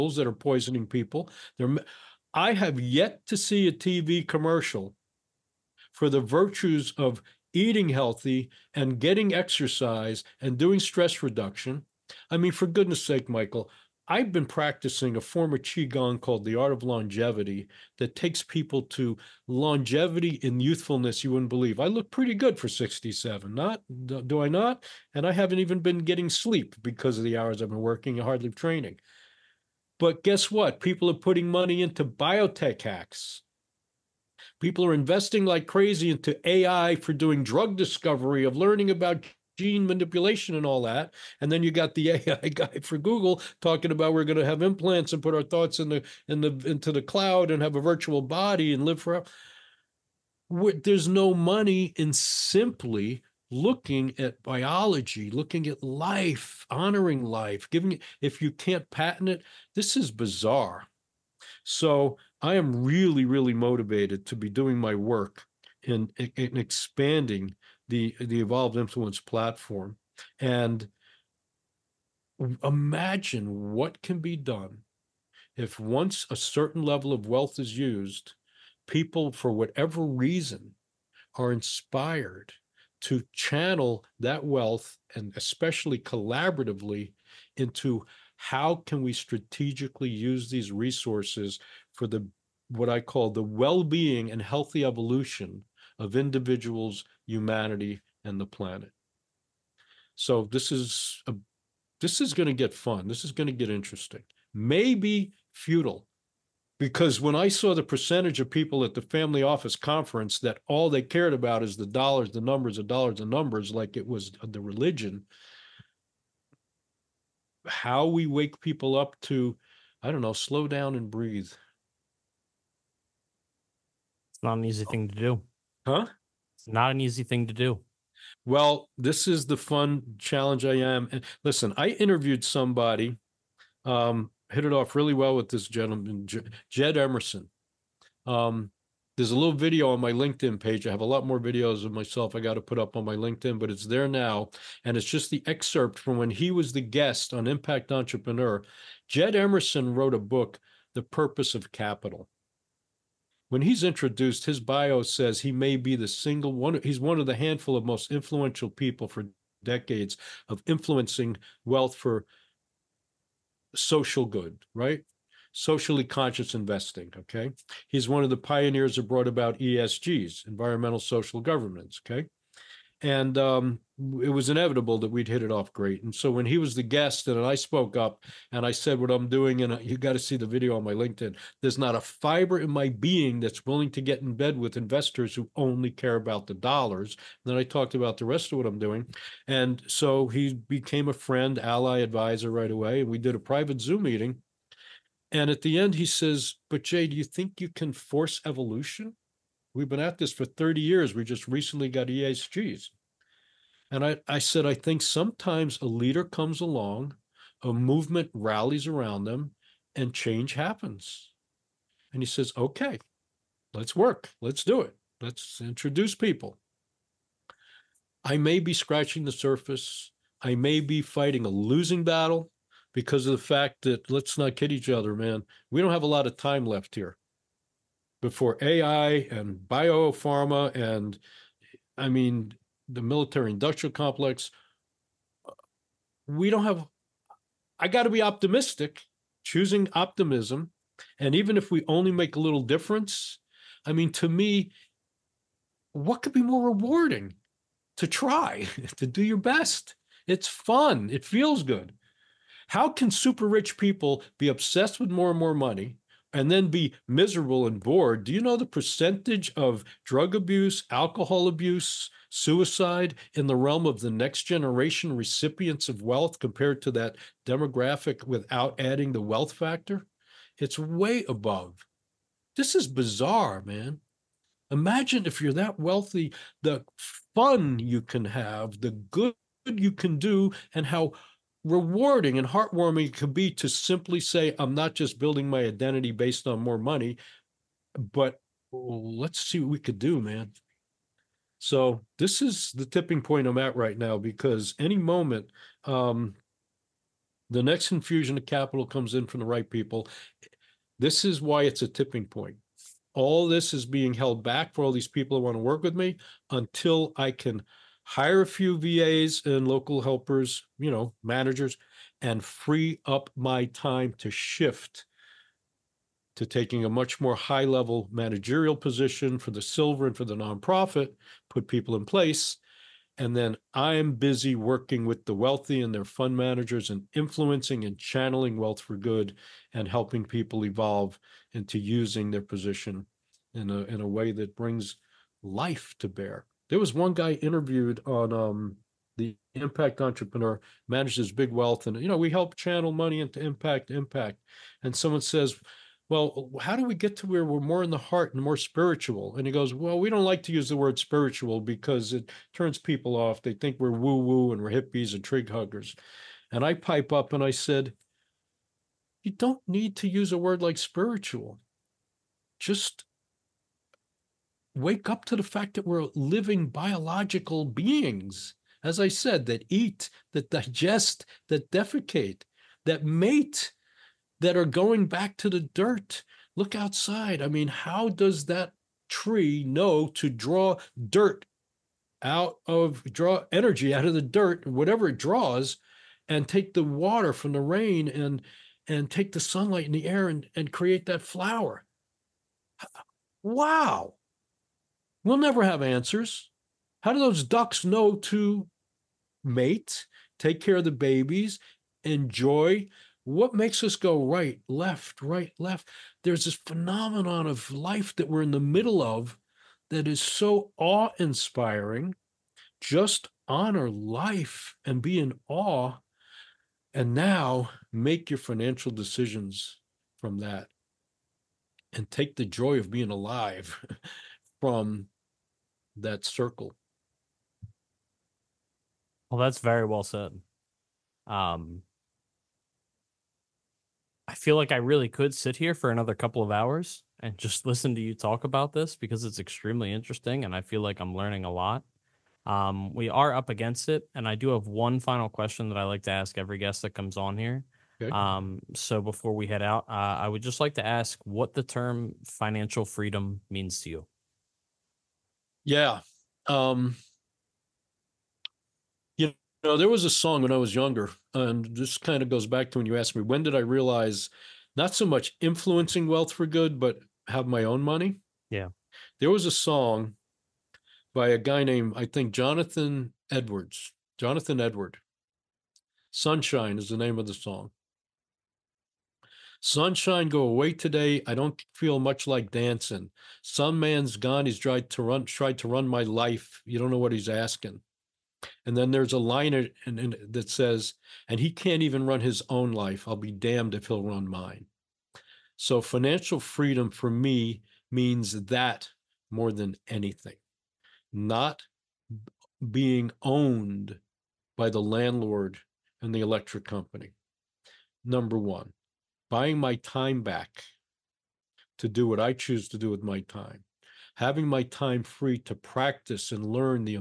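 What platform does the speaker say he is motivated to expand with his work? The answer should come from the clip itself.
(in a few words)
Evolved Influence.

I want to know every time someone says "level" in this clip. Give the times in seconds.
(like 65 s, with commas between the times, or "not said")
76 s, 317 s.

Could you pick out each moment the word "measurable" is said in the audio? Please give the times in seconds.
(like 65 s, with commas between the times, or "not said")
not said.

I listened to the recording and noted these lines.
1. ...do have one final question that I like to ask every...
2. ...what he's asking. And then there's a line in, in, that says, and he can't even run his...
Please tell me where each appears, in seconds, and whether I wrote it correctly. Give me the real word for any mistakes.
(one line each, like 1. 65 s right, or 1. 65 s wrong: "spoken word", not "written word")
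1. 444 s right
2. 486 s right.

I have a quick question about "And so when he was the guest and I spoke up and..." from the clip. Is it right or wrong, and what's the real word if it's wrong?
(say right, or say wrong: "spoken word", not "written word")
right.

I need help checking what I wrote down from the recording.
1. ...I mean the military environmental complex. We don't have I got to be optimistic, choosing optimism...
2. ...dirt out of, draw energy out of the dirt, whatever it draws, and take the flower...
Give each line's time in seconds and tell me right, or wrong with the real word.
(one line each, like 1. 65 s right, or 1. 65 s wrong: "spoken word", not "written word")
1. 231 s wrong: "industrial", not "environmental"
2. 381 s wrong: "water", not "flower".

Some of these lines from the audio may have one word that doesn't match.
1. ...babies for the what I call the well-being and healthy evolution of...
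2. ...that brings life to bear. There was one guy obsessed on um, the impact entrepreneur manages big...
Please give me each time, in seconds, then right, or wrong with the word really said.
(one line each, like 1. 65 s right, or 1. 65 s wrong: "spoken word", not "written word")
1. 90 s wrong: "resources", not "babies"
2. 334 s wrong: "interviewed", not "obsessed".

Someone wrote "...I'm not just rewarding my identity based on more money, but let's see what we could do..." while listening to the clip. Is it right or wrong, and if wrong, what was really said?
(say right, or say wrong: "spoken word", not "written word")
wrong: "building", not "rewarding".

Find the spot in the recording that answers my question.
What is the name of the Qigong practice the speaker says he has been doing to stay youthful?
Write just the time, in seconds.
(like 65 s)
16 s.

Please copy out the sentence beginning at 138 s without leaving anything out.
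Um, there's a little video on my LinkedIn page.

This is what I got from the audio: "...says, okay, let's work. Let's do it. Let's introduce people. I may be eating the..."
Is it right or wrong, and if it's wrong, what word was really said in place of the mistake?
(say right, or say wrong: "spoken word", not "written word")
wrong: "scratching", not "eating".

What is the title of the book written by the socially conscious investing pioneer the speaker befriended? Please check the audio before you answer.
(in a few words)
The Purpose of Capital.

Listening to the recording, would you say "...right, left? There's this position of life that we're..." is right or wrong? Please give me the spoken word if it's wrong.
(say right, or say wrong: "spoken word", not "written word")
wrong: "phenomenon", not "position".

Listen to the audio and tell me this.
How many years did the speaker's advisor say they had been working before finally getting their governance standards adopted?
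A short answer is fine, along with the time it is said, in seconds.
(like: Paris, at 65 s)
30, at 200 s.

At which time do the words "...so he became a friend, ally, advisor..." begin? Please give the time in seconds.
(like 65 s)
189 s.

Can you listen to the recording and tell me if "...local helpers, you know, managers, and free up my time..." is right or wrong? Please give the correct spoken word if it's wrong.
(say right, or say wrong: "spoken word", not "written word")
right.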